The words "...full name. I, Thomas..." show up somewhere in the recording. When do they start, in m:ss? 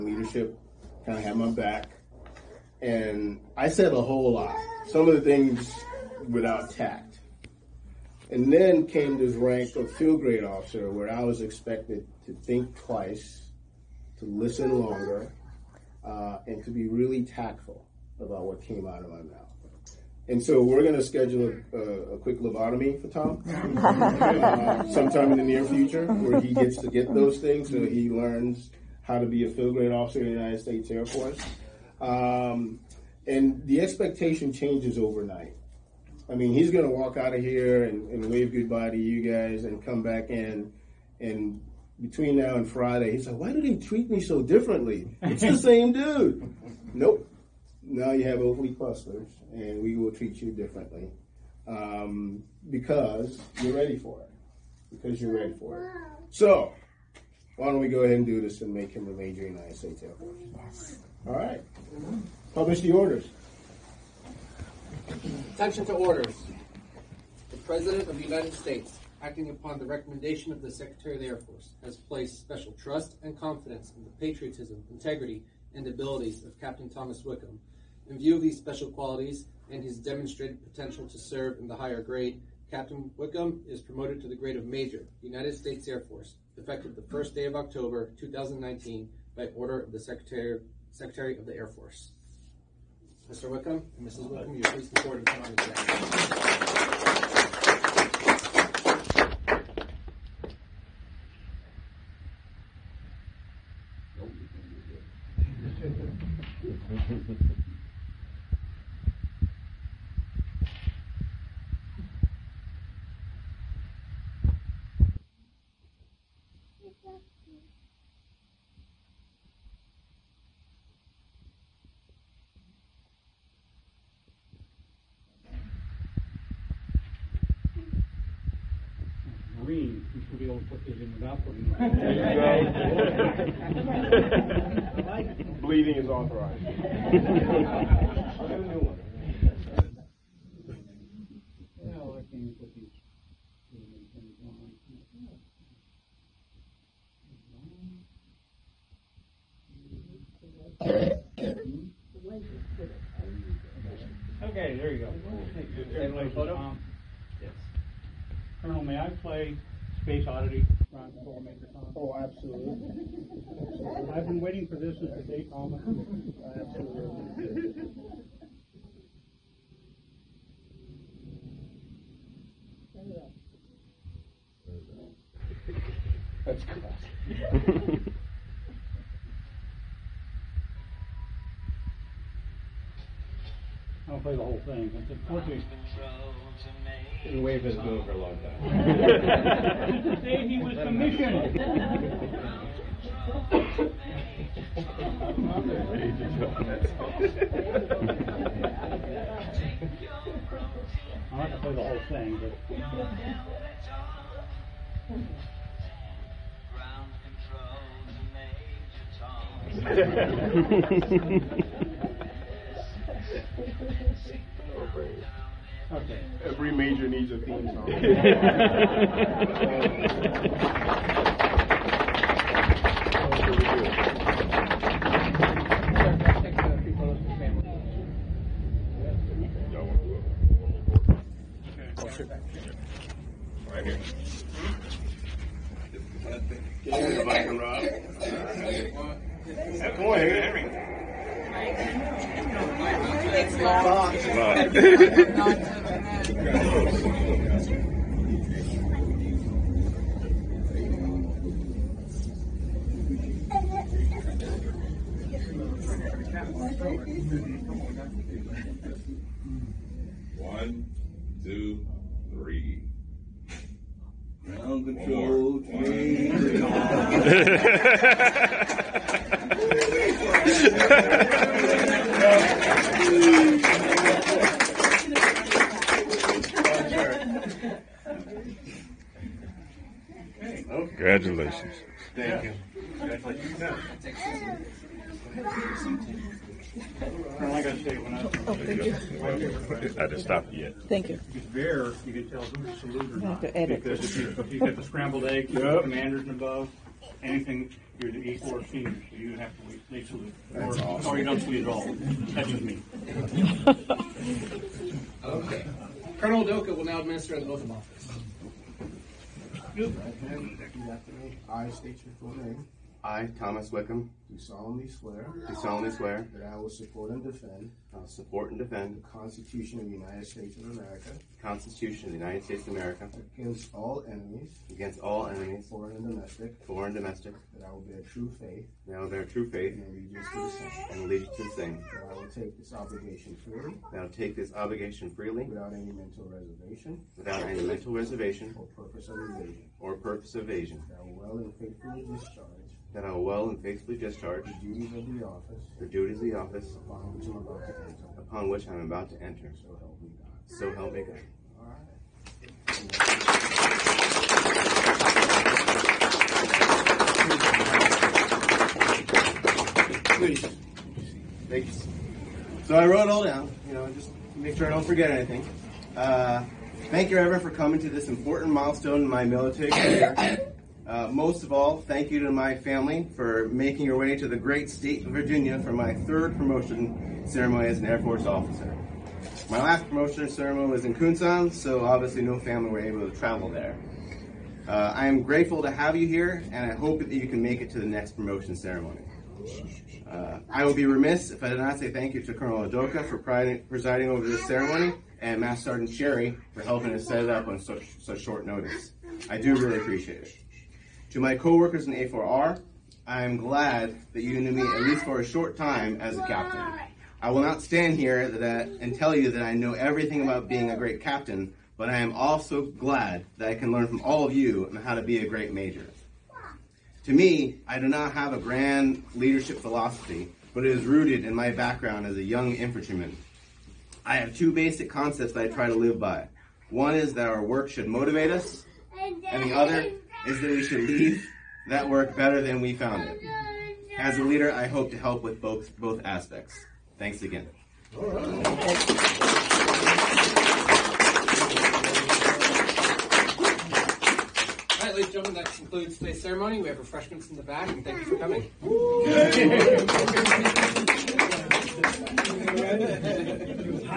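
5:12.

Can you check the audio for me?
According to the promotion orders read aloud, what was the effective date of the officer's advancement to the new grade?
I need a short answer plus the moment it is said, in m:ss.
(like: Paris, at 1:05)
1 October 2019, at 1:26.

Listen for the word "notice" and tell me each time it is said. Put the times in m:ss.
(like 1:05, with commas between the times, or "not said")
6:38.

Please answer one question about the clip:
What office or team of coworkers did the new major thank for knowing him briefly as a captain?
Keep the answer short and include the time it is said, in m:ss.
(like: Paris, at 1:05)
A4R, at 6:41.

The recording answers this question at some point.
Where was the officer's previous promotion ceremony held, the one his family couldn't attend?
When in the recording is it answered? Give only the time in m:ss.
6:20.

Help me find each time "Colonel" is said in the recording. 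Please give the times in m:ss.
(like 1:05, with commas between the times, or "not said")
5:06, 6:32.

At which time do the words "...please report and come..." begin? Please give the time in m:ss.
1:34.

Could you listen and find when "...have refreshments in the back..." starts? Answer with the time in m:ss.
7:26.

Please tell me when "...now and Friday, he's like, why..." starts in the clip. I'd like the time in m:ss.
0:42.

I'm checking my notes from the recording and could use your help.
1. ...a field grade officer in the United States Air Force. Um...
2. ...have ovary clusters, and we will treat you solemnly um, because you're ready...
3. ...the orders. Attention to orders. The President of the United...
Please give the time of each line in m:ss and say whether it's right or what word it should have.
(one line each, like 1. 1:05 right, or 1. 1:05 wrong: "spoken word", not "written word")
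1. 0:29 right
2. 0:48 wrong: "differently", not "solemnly"
3. 1:02 right.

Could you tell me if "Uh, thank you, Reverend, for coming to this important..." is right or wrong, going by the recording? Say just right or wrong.
right.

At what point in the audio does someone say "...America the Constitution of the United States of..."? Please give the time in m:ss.
5:20.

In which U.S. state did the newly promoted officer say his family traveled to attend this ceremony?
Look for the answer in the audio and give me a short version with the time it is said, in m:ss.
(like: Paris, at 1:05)
Virginia, at 6:15.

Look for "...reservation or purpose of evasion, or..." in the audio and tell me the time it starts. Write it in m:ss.
5:37.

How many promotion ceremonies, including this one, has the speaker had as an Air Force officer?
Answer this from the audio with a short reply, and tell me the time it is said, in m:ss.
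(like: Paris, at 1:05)
3, at 6:15.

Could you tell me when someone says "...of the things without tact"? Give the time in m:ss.
0:05.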